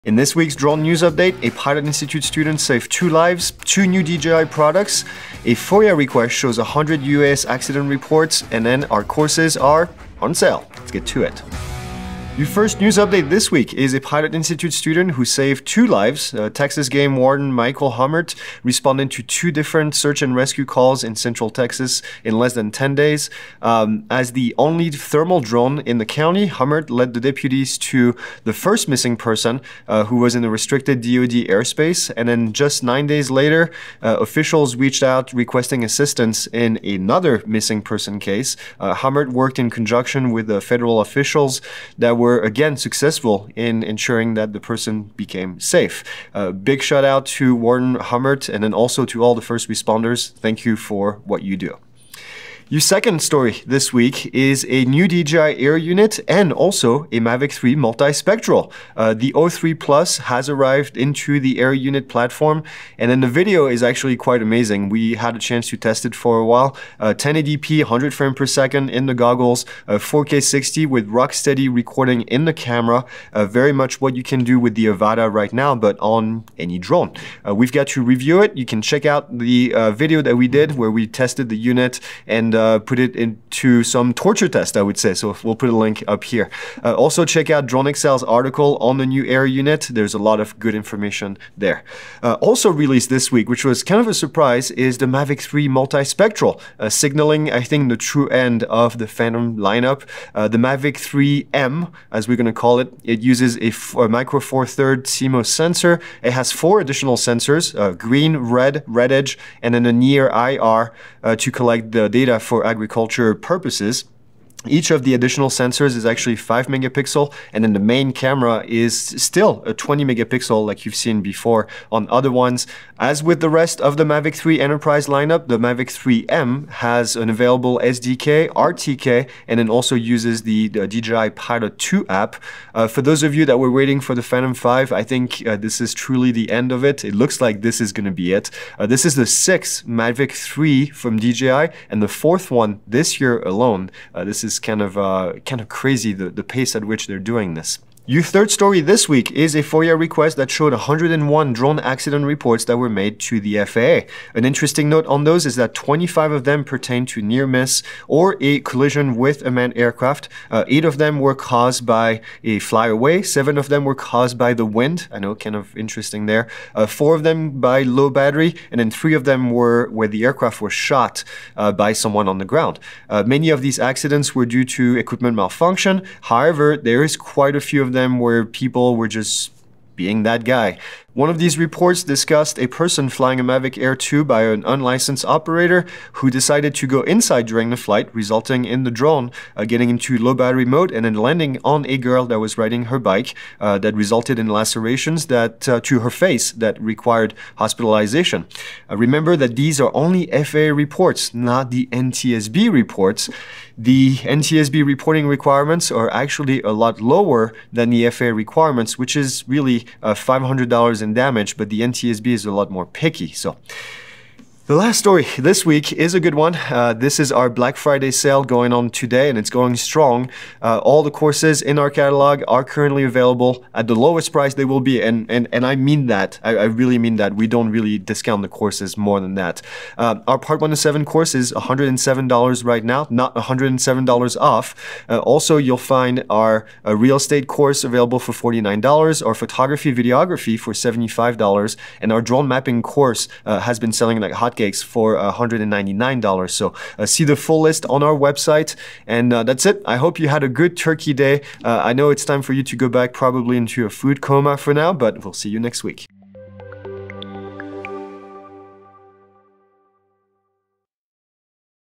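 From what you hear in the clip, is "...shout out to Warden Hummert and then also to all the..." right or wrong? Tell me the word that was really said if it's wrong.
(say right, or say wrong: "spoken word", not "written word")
right.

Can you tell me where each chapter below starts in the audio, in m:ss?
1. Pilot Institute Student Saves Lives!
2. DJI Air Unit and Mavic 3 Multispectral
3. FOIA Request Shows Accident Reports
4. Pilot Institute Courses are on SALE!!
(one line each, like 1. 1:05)
1. 0:12
2. 0:51
3. 2:28
4. 3:33.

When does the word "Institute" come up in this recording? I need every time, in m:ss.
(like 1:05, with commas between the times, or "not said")
0:01, 0:14.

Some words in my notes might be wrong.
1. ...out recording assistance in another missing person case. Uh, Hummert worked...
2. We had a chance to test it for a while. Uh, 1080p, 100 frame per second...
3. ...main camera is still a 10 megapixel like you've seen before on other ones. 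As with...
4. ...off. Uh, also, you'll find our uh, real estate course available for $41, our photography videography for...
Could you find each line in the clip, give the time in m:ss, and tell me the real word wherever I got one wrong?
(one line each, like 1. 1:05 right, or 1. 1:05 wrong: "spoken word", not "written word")
1. 0:35 wrong: "requesting", not "recording"
2. 1:04 right
3. 1:57 wrong: "20", not "10"
4. 3:54 wrong: "49", not "41".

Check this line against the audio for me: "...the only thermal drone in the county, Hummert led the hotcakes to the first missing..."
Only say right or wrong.
wrong.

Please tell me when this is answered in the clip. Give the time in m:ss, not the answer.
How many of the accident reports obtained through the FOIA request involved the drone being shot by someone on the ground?
2:48.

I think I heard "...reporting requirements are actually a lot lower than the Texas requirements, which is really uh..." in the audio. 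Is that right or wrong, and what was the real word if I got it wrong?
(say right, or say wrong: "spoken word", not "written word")
wrong: "FAA", not "Texas".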